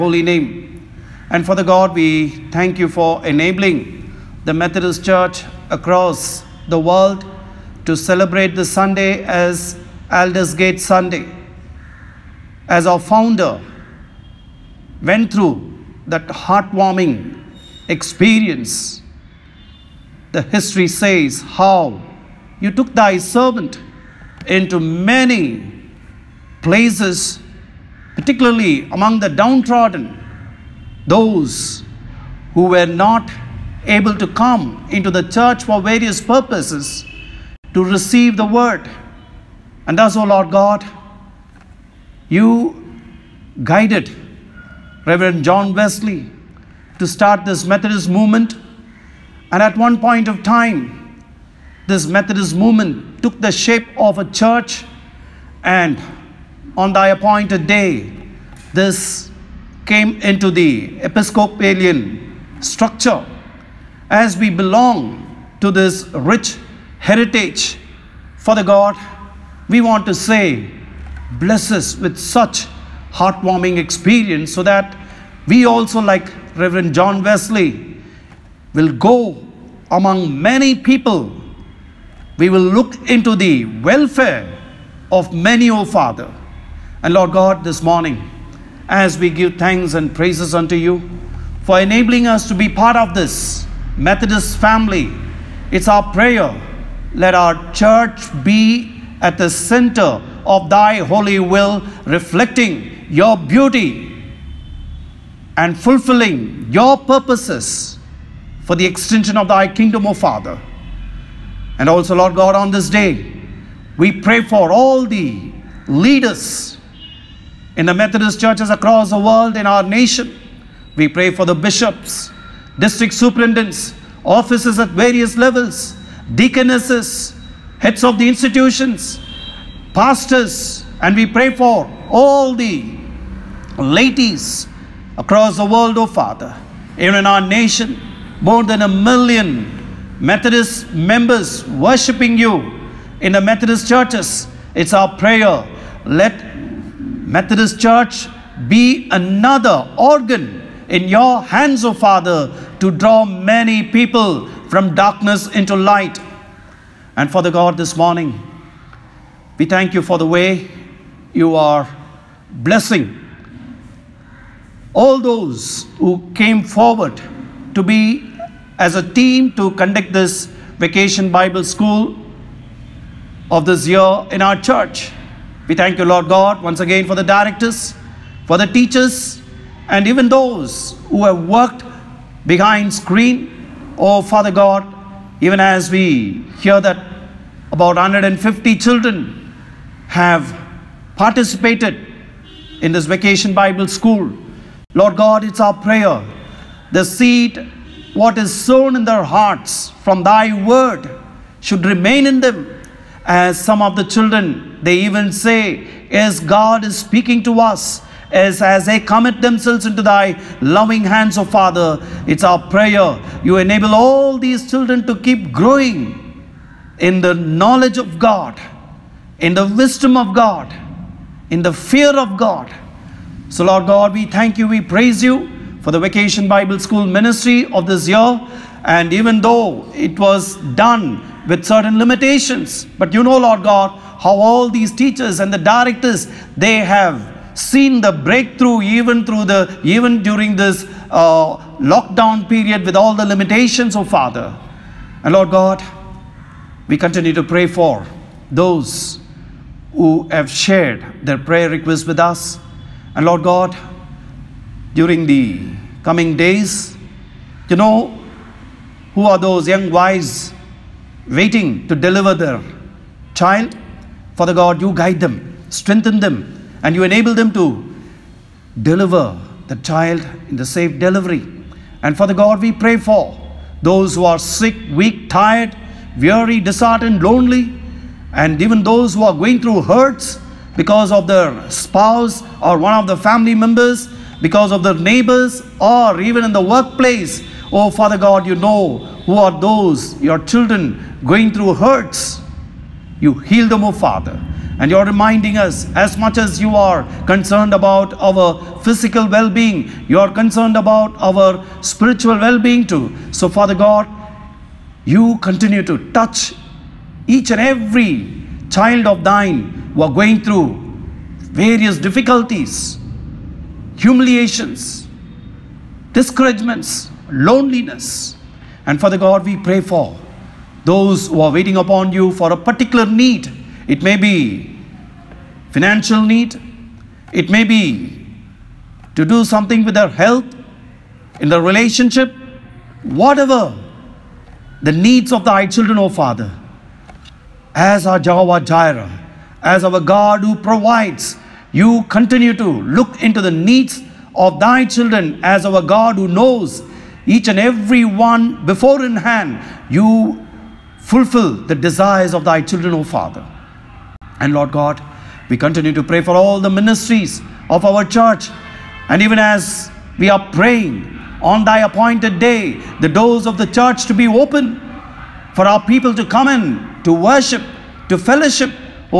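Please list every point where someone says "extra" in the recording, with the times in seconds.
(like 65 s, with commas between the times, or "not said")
not said.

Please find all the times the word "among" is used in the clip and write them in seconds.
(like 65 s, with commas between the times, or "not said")
28 s, 79 s.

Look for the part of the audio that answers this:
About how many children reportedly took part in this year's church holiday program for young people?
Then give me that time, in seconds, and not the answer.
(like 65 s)
187 s.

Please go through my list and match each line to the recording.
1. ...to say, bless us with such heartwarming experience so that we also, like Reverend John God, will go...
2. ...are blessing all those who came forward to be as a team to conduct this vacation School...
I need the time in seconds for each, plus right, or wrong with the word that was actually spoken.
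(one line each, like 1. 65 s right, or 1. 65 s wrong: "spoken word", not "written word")
1. 70 s wrong: "Wesley", not "God"
2. 161 s wrong: "Bible", not "School".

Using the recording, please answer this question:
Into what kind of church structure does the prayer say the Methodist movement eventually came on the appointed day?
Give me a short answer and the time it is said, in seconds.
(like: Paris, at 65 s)
Episcopalian, at 61 s.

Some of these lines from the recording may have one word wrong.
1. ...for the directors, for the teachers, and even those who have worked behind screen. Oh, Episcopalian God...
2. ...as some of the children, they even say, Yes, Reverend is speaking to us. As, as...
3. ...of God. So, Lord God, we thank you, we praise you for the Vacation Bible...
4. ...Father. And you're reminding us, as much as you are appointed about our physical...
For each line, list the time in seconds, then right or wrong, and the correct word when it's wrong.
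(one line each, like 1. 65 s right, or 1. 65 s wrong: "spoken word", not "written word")
1. 177 s wrong: "Father", not "Episcopalian"
2. 203 s wrong: "God", not "Reverend"
3. 222 s right
4. 293 s wrong: "concerned", not "appointed".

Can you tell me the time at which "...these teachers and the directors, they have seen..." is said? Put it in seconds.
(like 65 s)
234 s.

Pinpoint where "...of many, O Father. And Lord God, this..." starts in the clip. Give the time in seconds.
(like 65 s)
85 s.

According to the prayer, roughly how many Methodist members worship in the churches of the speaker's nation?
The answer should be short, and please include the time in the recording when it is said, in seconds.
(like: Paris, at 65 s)
more than a million, at 138 s.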